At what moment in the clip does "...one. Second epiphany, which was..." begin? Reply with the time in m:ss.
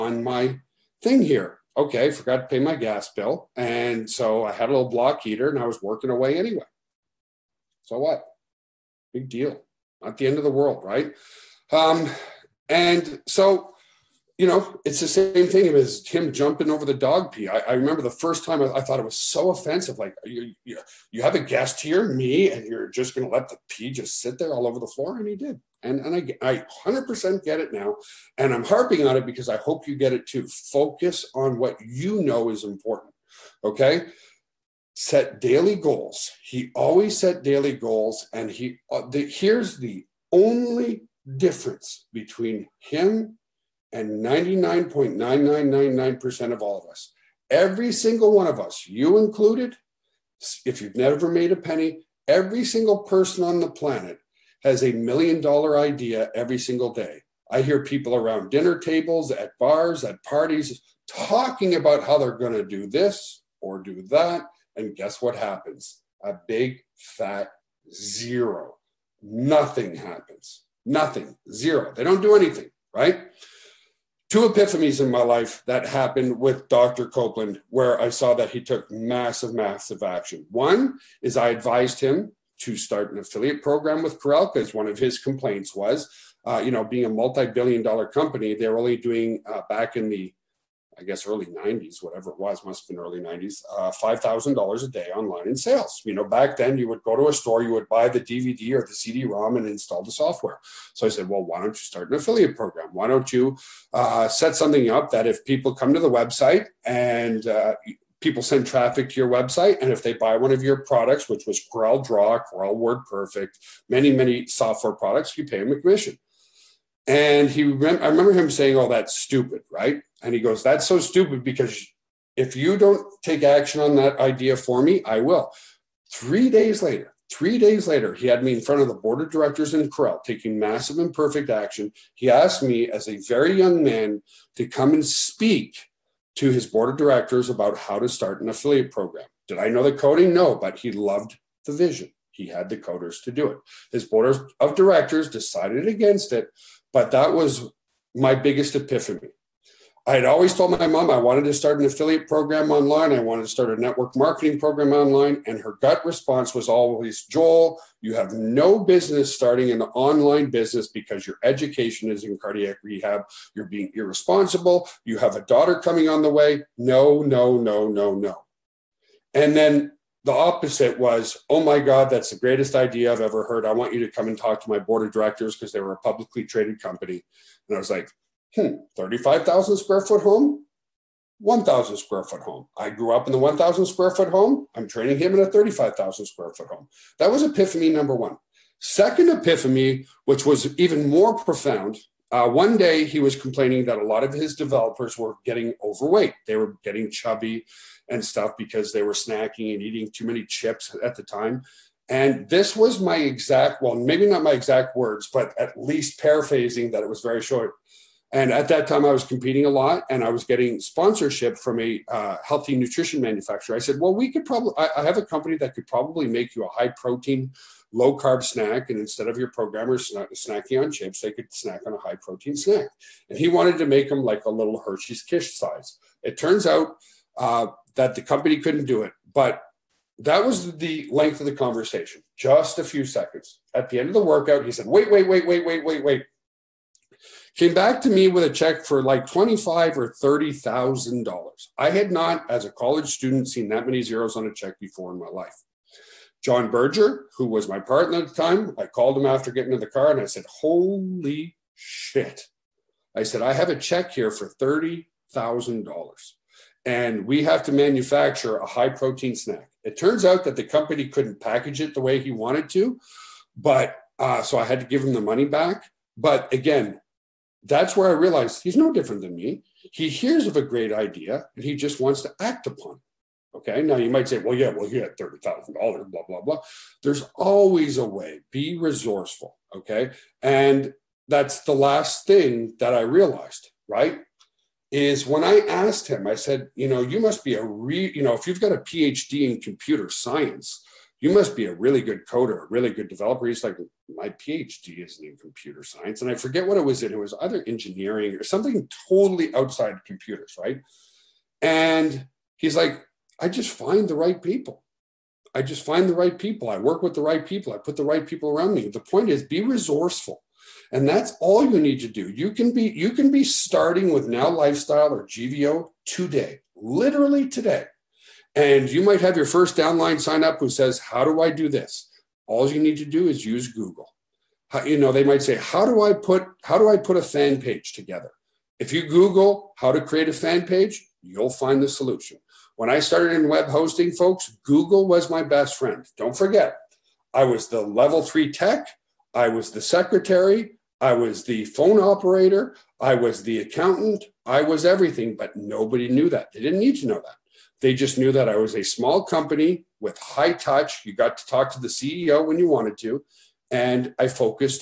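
3:08.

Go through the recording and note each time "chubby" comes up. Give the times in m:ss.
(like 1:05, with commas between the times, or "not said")
3:17.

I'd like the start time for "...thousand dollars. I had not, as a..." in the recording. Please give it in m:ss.
4:00.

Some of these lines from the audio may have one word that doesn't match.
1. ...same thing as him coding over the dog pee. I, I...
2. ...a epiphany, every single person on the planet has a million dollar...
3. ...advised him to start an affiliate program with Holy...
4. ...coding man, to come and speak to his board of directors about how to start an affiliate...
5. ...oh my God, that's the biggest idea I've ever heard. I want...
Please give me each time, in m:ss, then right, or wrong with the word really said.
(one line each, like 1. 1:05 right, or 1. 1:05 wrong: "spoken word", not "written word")
1. 0:15 wrong: "jumping", not "coding"
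2. 0:51 wrong: "penny", not "epiphany"
3. 1:21 wrong: "Corel", not "Holy"
4. 2:13 wrong: "young", not "coding"
5. 2:51 wrong: "greatest", not "biggest".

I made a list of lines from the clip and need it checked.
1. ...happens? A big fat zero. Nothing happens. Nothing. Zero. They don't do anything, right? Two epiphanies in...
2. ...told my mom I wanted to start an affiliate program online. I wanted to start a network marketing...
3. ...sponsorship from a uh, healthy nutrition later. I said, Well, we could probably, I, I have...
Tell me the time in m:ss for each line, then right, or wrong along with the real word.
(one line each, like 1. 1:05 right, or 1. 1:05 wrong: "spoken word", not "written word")
1. 1:05 right
2. 2:30 right
3. 3:30 wrong: "manufacturer", not "later".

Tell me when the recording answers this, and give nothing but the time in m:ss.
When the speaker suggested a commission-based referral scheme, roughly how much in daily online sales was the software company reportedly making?
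1:33.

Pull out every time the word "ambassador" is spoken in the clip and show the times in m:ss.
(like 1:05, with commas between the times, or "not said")
not said.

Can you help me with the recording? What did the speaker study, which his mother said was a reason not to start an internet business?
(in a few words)
Cardiac rehab.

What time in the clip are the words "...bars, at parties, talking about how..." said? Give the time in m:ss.
0:59.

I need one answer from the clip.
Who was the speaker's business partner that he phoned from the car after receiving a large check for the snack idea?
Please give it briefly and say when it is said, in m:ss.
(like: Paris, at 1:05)
John Berger, at 4:06.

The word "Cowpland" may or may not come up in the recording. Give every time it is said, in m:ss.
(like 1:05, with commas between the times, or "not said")
1:17.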